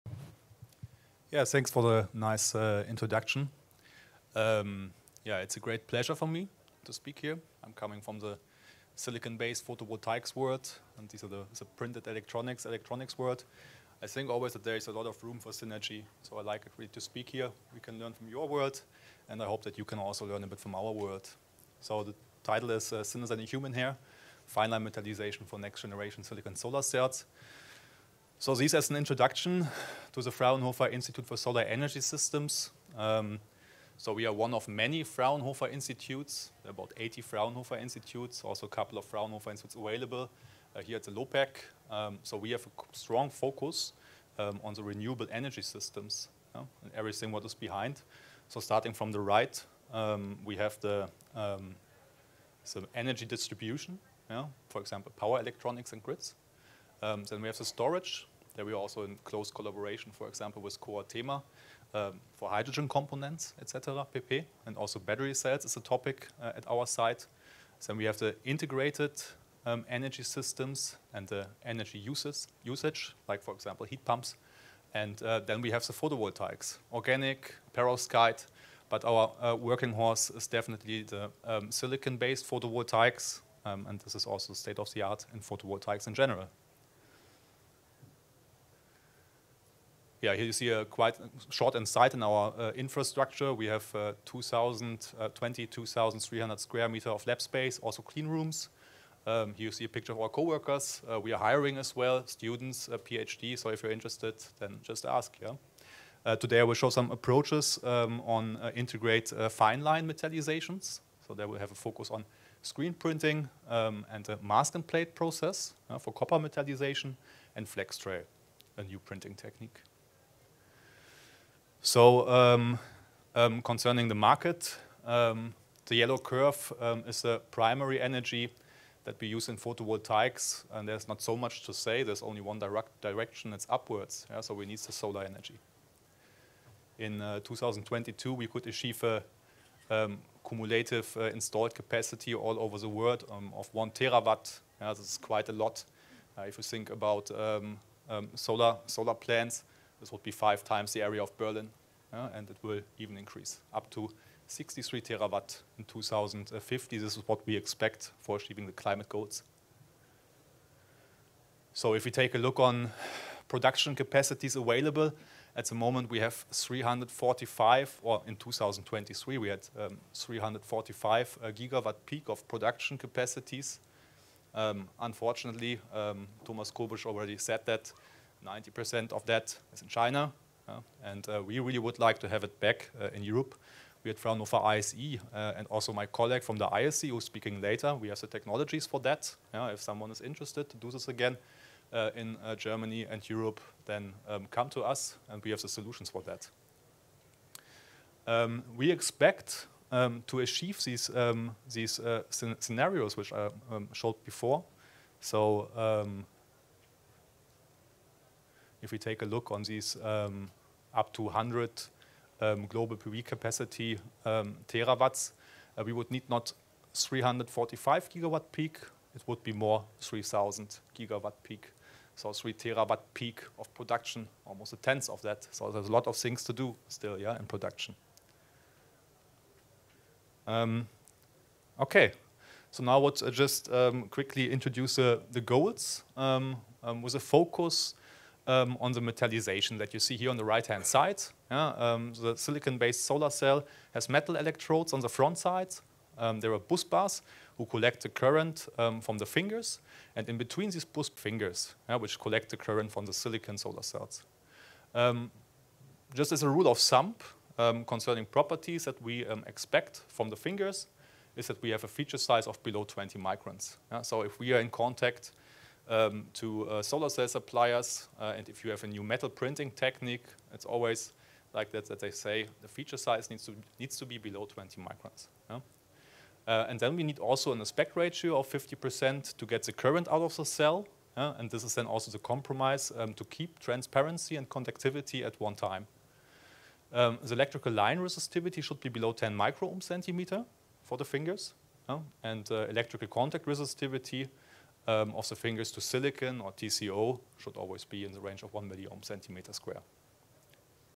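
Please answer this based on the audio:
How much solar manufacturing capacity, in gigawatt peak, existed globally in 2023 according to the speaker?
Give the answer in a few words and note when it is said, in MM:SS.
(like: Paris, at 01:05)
345 gigawatt peak, at 02:50.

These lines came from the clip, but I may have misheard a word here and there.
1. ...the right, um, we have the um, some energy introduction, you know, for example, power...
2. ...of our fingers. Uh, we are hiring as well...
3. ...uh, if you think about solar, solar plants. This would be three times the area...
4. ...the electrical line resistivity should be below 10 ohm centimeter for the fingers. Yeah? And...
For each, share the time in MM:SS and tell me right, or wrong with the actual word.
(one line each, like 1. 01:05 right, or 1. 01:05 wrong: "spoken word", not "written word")
1. 00:49 wrong: "distribution", not "introduction"
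2. 01:40 wrong: "coworkers", not "fingers"
3. 02:26 wrong: "five", not "three"
4. 04:47 right.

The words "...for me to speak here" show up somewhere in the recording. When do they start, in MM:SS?
00:06.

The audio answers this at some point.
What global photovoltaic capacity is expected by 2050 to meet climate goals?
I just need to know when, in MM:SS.
02:34.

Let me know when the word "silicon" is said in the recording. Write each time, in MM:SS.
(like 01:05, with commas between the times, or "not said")
00:08, 00:26, 01:21, 04:02, 04:13, 04:55.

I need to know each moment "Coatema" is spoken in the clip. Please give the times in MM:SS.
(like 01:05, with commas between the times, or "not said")
01:00.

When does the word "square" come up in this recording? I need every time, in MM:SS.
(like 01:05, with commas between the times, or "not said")
01:36, 04:59.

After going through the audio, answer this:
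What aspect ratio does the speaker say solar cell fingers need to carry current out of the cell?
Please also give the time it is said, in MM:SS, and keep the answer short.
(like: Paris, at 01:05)
50%, at 04:38.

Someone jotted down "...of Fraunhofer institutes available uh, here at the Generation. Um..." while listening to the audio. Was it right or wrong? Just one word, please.
wrong.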